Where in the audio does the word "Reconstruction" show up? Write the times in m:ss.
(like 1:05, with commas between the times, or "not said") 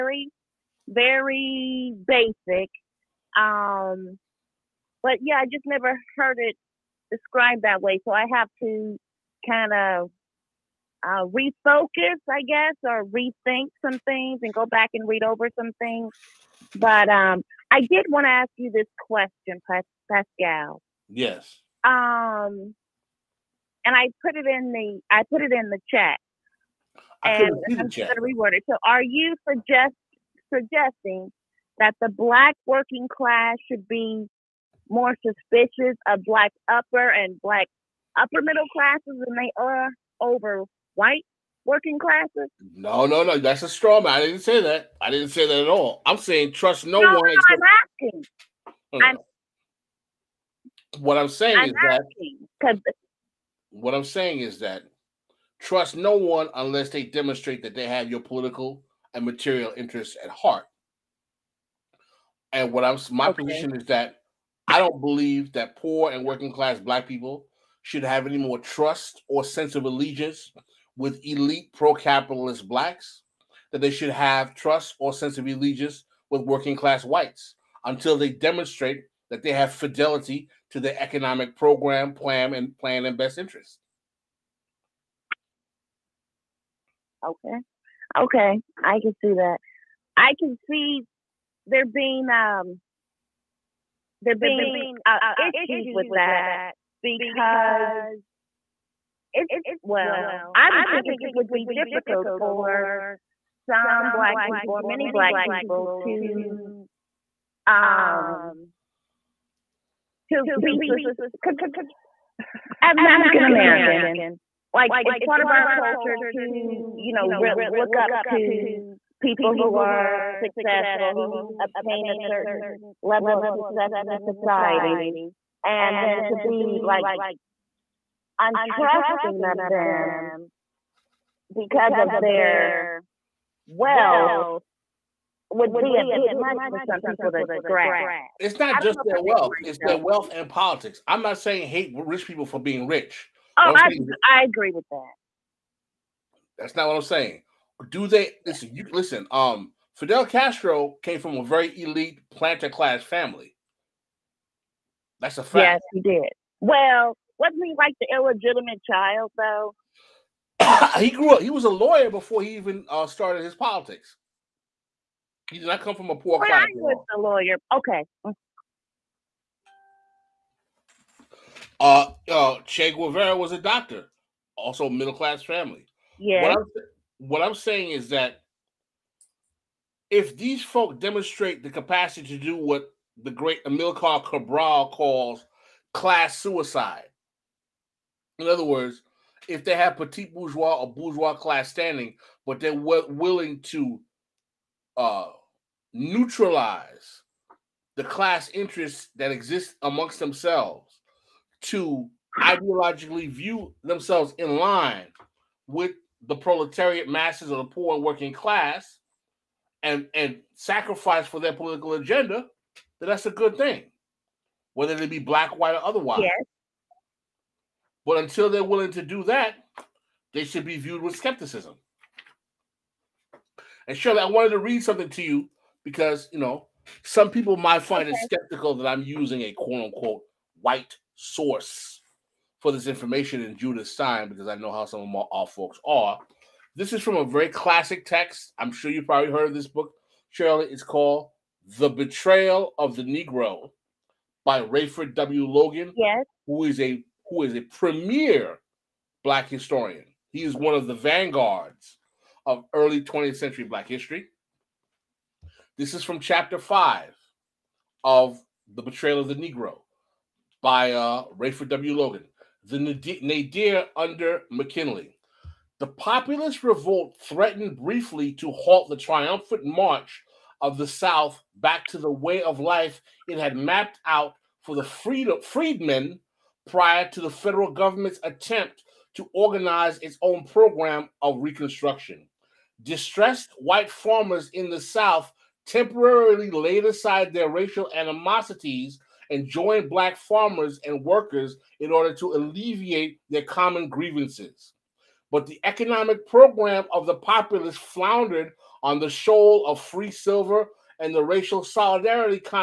4:41.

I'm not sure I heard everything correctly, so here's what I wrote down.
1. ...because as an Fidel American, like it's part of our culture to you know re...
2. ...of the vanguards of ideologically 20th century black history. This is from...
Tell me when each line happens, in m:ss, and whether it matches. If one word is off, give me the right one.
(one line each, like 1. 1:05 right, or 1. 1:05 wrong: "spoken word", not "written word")
1. 1:50 wrong: "African", not "Fidel"
2. 4:10 wrong: "early", not "ideologically".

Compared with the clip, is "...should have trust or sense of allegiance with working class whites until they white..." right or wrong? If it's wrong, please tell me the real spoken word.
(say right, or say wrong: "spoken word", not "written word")
wrong: "demonstrate", not "white".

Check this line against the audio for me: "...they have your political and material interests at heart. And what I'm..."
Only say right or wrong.
right.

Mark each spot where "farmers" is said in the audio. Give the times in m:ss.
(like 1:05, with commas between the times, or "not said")
4:43, 4:50.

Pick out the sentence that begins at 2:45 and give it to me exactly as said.
He did not come from a poor well, class.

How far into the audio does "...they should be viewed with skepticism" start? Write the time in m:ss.
3:40.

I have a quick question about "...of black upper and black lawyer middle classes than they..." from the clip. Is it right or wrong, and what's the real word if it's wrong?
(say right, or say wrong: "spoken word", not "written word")
wrong: "upper", not "lawyer".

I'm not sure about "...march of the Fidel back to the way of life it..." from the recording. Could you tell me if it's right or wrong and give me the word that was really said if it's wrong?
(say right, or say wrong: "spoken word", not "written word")
wrong: "South", not "Fidel".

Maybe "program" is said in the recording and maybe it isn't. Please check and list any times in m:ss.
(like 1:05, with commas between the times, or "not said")
1:21, 4:40, 4:56.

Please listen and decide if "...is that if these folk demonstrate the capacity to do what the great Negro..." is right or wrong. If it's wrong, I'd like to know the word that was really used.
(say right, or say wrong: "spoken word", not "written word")
wrong: "Amilcar", not "Negro".